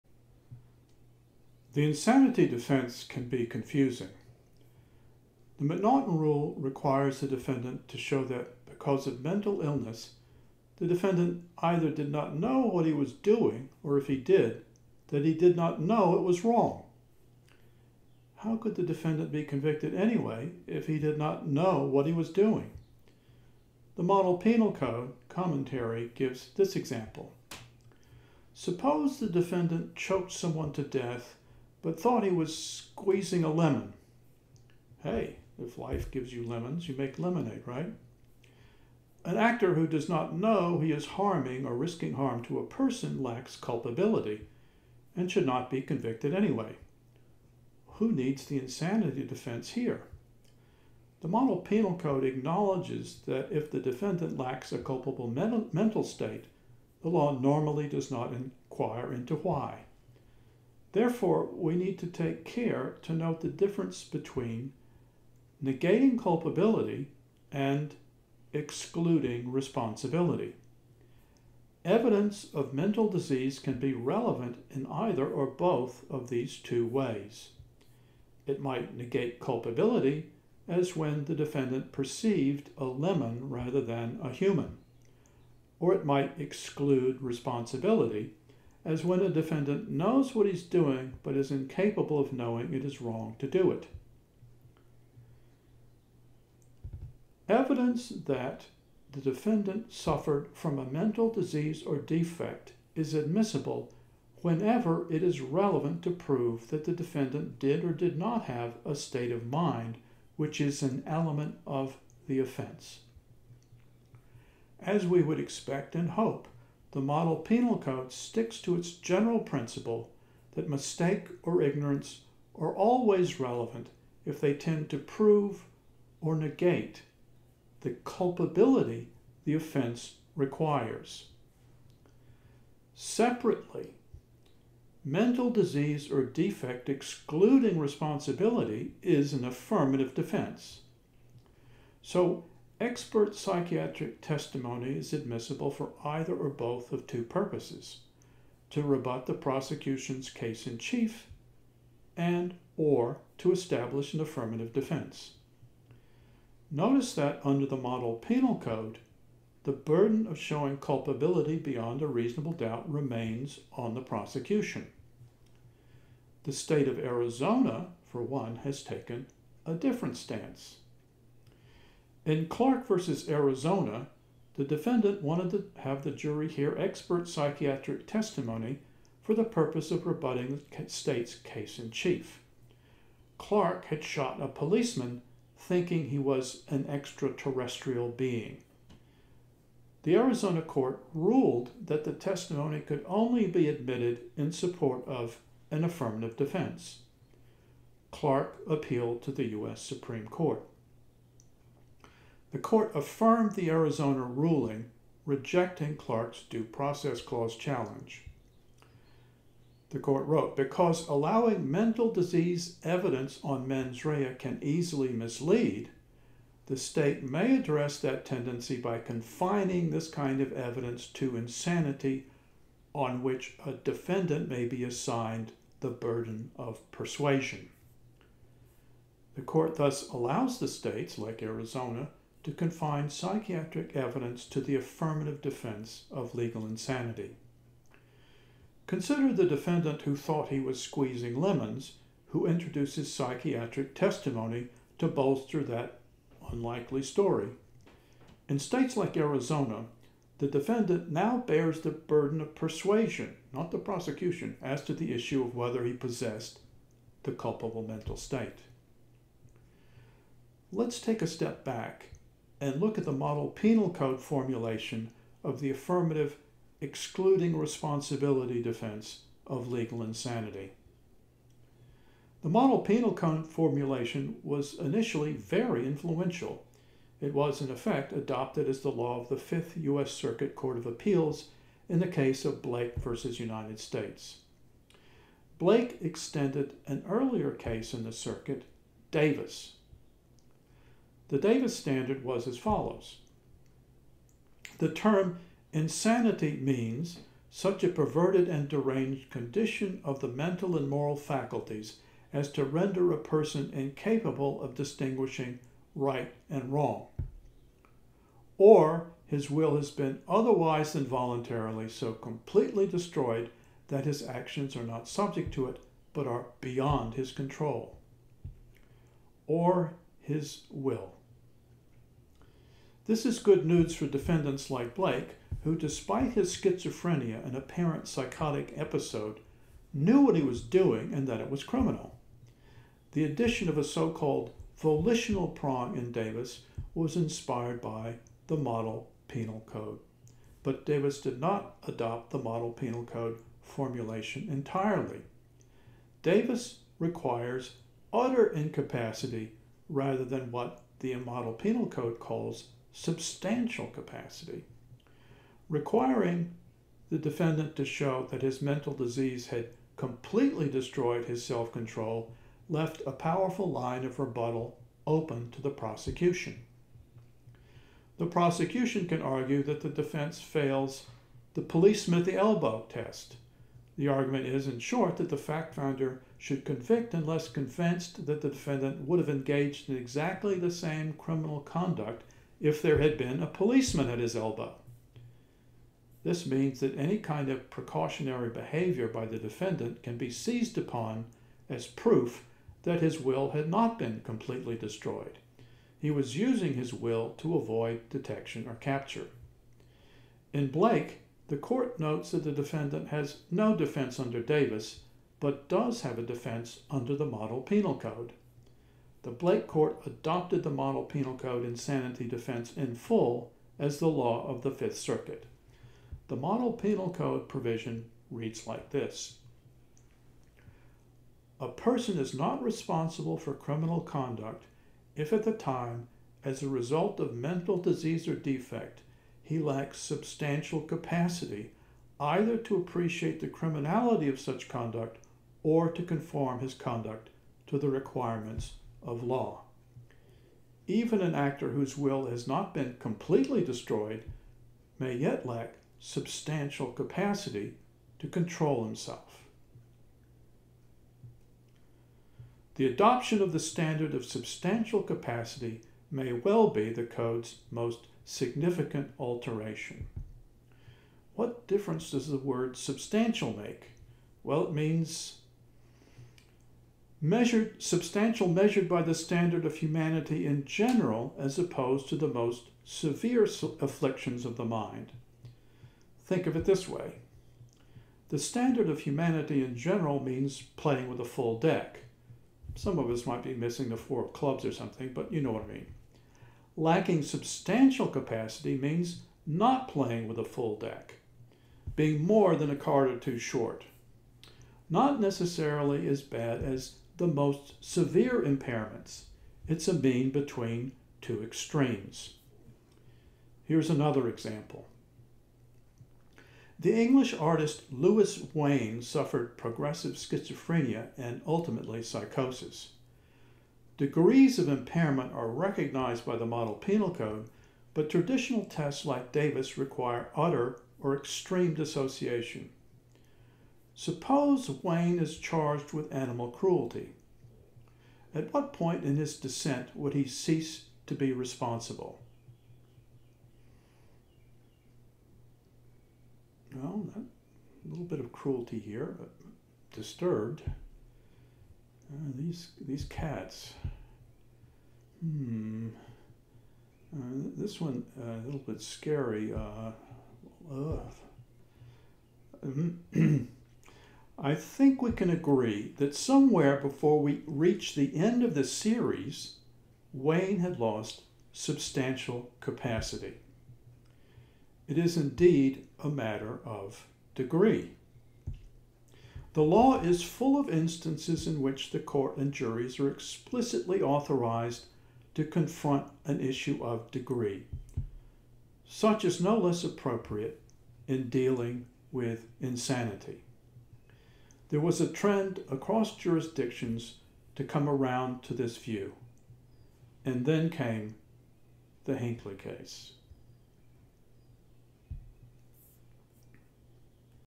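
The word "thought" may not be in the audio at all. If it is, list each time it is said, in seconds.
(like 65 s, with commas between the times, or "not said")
31 s, 240 s.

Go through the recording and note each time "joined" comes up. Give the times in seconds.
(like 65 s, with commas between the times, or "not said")
not said.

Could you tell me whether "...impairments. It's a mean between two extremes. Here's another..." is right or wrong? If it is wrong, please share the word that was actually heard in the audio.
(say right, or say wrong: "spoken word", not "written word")
right.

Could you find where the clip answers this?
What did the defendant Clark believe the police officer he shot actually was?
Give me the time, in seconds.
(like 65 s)
186 s.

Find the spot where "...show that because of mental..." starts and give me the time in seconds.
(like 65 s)
7 s.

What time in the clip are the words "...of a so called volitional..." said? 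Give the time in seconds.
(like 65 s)
333 s.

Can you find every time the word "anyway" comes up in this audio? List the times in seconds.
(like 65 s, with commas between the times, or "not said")
19 s, 46 s.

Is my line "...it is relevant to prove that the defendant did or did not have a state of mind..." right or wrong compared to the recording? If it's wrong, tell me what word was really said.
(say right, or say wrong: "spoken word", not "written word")
right.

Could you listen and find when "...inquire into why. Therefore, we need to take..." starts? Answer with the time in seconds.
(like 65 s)
58 s.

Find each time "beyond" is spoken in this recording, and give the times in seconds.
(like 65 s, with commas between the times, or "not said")
161 s, 316 s.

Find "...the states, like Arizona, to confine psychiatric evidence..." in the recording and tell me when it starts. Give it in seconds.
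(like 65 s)
230 s.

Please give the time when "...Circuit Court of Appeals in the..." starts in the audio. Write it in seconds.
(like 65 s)
280 s.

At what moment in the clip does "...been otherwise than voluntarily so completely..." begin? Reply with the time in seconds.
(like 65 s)
309 s.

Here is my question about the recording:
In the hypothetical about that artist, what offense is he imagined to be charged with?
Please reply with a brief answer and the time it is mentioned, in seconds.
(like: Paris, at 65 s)
Animal cruelty, at 526 s.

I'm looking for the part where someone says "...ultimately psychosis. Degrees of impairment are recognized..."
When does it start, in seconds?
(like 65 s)
511 s.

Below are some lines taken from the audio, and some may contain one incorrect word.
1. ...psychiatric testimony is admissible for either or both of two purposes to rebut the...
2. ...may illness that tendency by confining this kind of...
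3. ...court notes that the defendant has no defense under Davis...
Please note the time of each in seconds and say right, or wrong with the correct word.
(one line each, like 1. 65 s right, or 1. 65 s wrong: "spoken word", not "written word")
1. 143 s right
2. 217 s wrong: "address", not "illness"
3. 401 s right.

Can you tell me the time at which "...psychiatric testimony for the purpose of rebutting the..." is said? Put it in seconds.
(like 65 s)
177 s.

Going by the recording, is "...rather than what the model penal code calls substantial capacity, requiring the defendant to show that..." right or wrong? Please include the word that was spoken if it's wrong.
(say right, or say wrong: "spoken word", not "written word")
right.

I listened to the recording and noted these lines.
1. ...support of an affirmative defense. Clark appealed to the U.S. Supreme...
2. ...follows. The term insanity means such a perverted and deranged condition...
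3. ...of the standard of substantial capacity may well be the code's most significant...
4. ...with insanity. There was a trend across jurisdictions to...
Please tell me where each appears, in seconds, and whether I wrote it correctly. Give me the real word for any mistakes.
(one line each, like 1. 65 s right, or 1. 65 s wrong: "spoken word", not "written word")
1. 194 s right
2. 292 s right
3. 453 s right
4. 582 s right.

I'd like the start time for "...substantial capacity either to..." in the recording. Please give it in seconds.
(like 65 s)
429 s.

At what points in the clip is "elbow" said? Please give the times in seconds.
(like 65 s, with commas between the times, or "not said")
372 s, 384 s.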